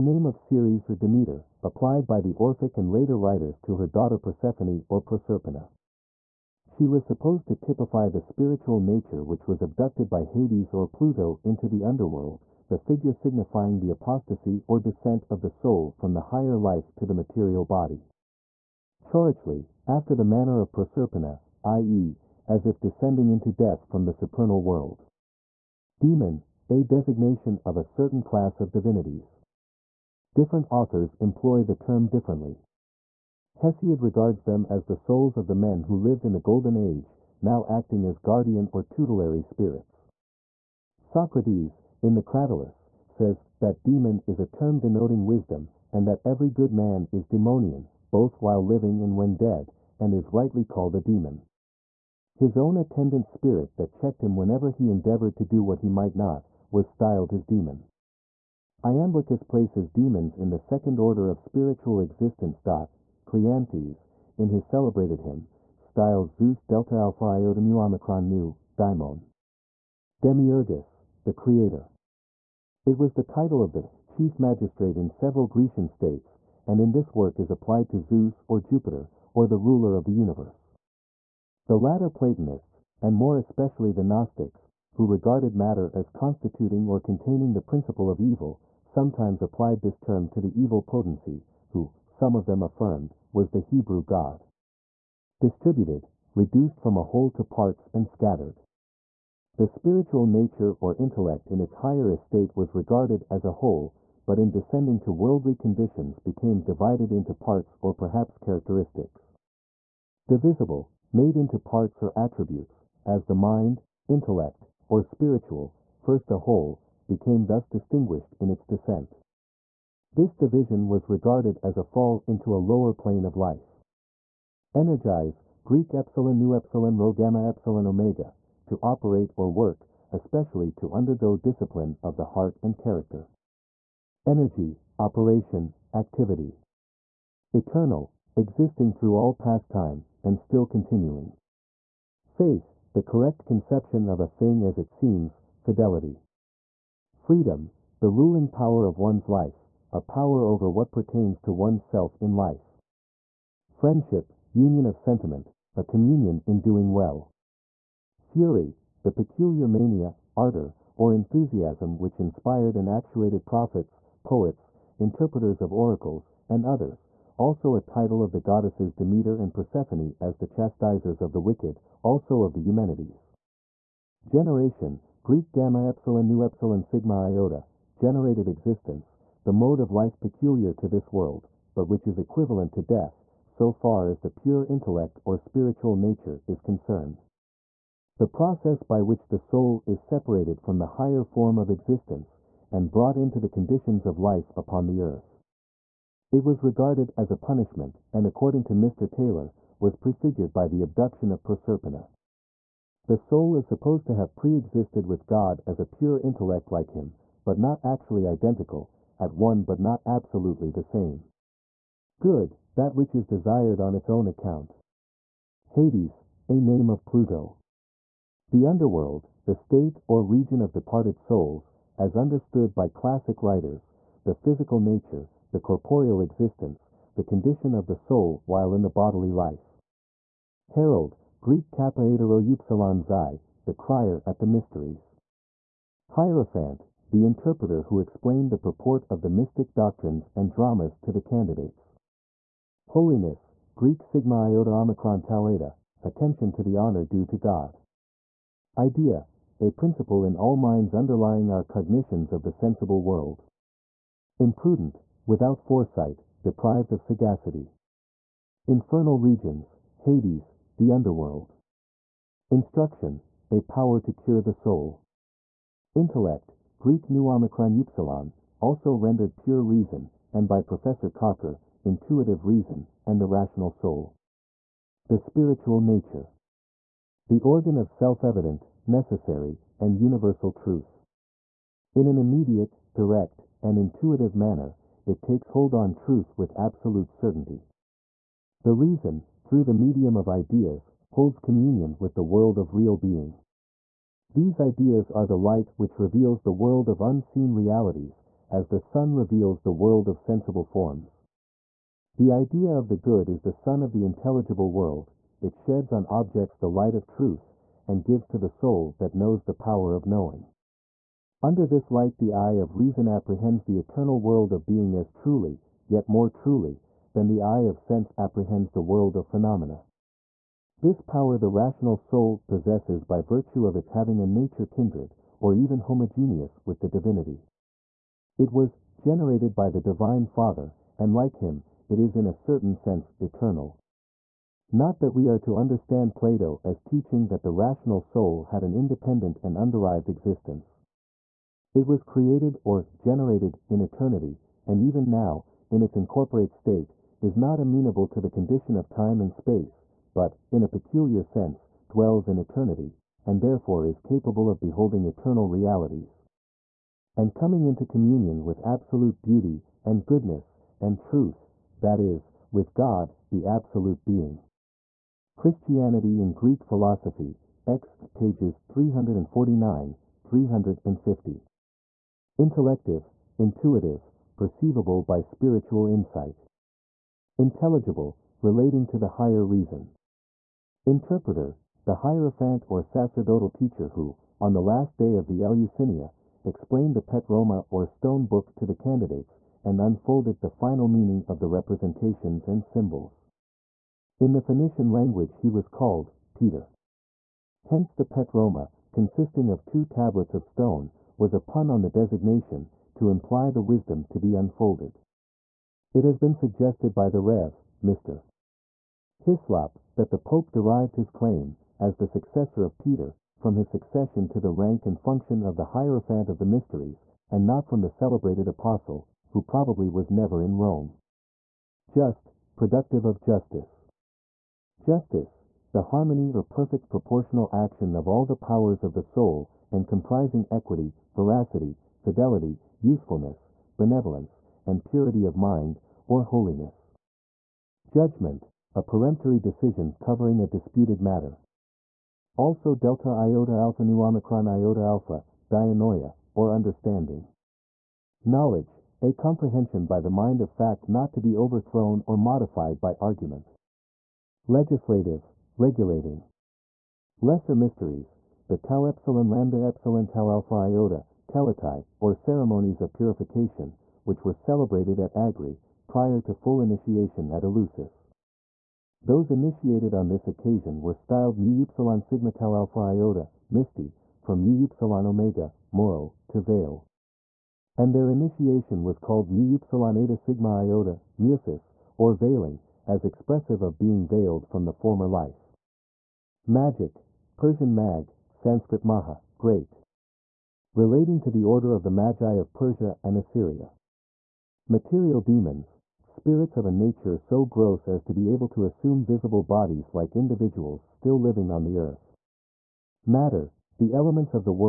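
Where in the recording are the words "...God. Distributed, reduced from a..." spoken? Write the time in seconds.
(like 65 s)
94 s.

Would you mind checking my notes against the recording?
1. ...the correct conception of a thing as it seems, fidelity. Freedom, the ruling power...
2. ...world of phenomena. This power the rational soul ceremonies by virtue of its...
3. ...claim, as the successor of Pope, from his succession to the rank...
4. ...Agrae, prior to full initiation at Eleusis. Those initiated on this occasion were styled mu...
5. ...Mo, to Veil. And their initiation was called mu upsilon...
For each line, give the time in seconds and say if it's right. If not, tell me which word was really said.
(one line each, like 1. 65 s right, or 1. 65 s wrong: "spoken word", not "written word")
1. 142 s right
2. 318 s wrong: "possesses", not "ceremonies"
3. 411 s wrong: "Peter", not "Pope"
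4. 465 s right
5. 475 s right.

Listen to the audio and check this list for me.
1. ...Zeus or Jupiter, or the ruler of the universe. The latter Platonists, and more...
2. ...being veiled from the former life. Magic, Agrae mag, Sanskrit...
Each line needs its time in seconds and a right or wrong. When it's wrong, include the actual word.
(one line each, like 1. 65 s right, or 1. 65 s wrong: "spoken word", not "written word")
1. 77 s right
2. 483 s wrong: "Persian", not "Agrae".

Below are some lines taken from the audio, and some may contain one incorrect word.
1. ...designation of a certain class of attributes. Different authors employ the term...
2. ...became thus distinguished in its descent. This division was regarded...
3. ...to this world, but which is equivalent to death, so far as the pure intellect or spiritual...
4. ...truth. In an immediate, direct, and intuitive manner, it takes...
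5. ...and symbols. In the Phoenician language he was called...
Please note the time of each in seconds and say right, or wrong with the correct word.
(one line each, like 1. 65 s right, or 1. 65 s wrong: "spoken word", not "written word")
1. 26 s wrong: "divinities", not "attributes"
2. 117 s right
3. 180 s right
4. 280 s right
5. 392 s right.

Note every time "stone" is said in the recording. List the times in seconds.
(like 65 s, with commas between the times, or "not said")
387 s, 400 s.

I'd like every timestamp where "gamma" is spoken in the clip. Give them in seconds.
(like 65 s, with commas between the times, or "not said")
127 s, 175 s.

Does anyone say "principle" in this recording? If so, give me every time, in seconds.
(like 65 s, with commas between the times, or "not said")
87 s, 249 s.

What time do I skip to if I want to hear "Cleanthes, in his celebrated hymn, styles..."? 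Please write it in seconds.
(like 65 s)
63 s.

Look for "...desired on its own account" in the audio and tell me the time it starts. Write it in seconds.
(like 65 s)
213 s.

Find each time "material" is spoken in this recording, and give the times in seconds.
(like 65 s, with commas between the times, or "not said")
17 s, 494 s.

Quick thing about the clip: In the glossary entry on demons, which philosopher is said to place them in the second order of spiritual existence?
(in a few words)
Iamblichus.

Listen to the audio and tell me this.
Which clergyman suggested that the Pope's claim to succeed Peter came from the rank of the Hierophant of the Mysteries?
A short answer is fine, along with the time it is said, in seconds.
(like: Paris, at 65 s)
Rev. Mr. Hislop, at 407 s.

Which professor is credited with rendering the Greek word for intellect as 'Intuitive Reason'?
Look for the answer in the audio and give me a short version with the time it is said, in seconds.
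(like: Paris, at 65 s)
Professor Cocker, at 270 s.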